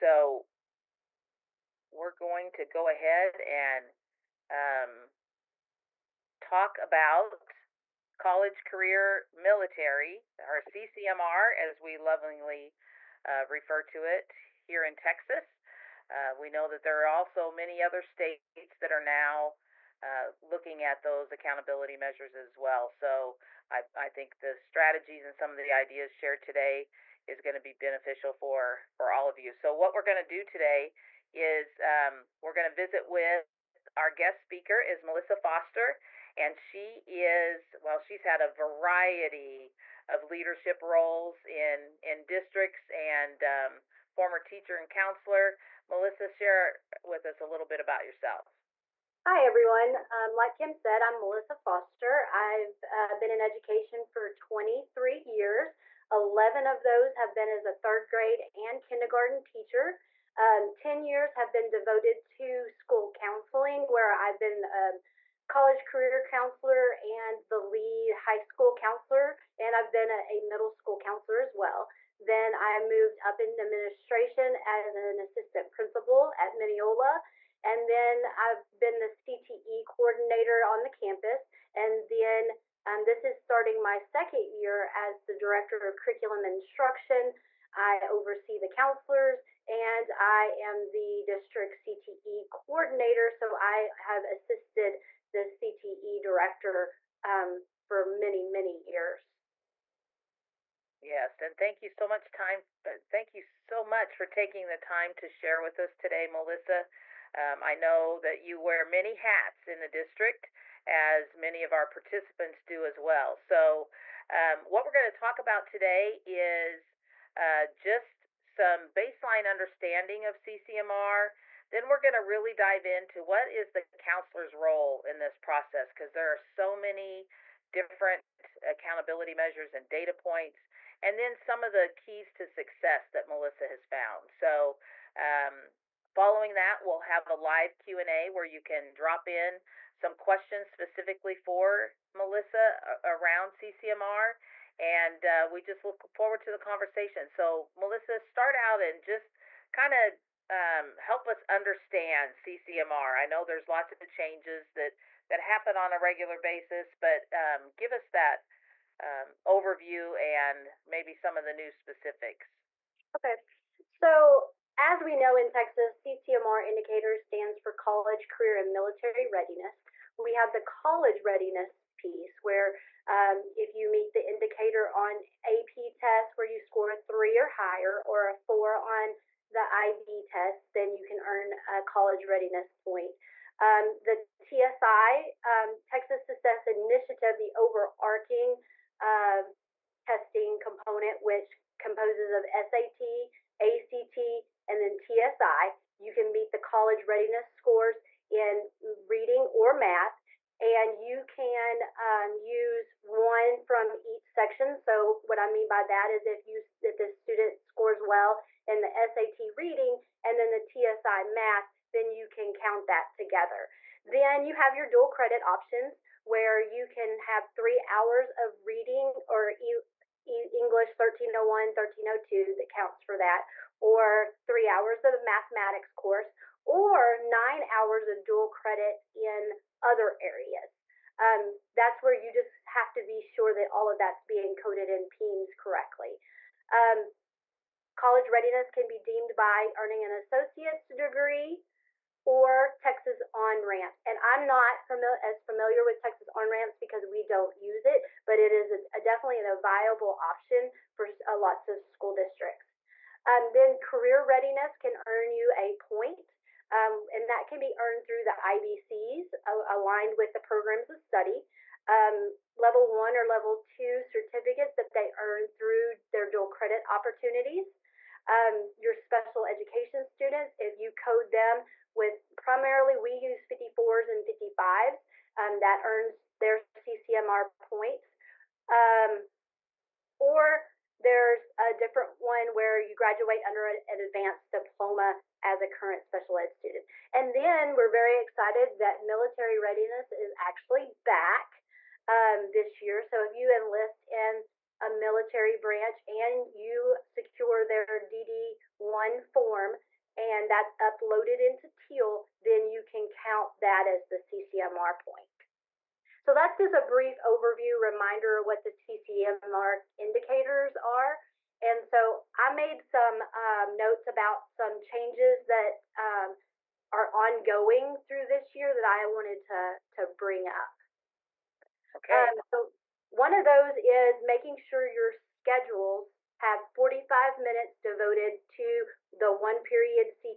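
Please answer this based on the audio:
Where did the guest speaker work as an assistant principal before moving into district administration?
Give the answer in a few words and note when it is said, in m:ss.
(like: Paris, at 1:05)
Mineola, at 1:16.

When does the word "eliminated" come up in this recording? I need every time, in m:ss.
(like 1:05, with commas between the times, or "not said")
not said.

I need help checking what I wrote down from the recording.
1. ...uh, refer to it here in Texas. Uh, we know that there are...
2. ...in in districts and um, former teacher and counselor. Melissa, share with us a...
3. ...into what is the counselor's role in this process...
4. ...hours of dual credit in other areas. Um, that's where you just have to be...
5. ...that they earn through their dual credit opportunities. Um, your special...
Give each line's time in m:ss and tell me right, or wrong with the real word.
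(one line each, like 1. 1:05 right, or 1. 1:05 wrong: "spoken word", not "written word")
1. 0:13 right
2. 0:41 right
3. 2:02 right
4. 3:47 right
5. 4:24 right.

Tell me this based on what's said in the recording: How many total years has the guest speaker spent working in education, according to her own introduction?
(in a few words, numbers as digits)
23.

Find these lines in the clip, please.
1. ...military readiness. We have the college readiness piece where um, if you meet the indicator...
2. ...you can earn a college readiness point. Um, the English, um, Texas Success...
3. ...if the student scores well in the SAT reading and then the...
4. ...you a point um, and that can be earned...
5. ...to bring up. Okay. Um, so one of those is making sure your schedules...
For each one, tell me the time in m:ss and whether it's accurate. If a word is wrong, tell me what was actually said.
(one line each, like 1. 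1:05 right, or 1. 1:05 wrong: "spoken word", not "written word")
1. 2:48 right
2. 3:00 wrong: "TSI", not "English"
3. 3:26 right
4. 4:15 right
5. 5:19 right.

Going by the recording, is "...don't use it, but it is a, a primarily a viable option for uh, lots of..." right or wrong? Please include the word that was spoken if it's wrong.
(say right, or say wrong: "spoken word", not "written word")
wrong: "definitely", not "primarily".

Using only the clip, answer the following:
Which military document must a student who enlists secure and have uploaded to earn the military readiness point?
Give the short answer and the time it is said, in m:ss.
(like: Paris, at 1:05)
DD1 form, at 4:58.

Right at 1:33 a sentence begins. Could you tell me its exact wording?
So I have assisted the CTE director um, for many, many years.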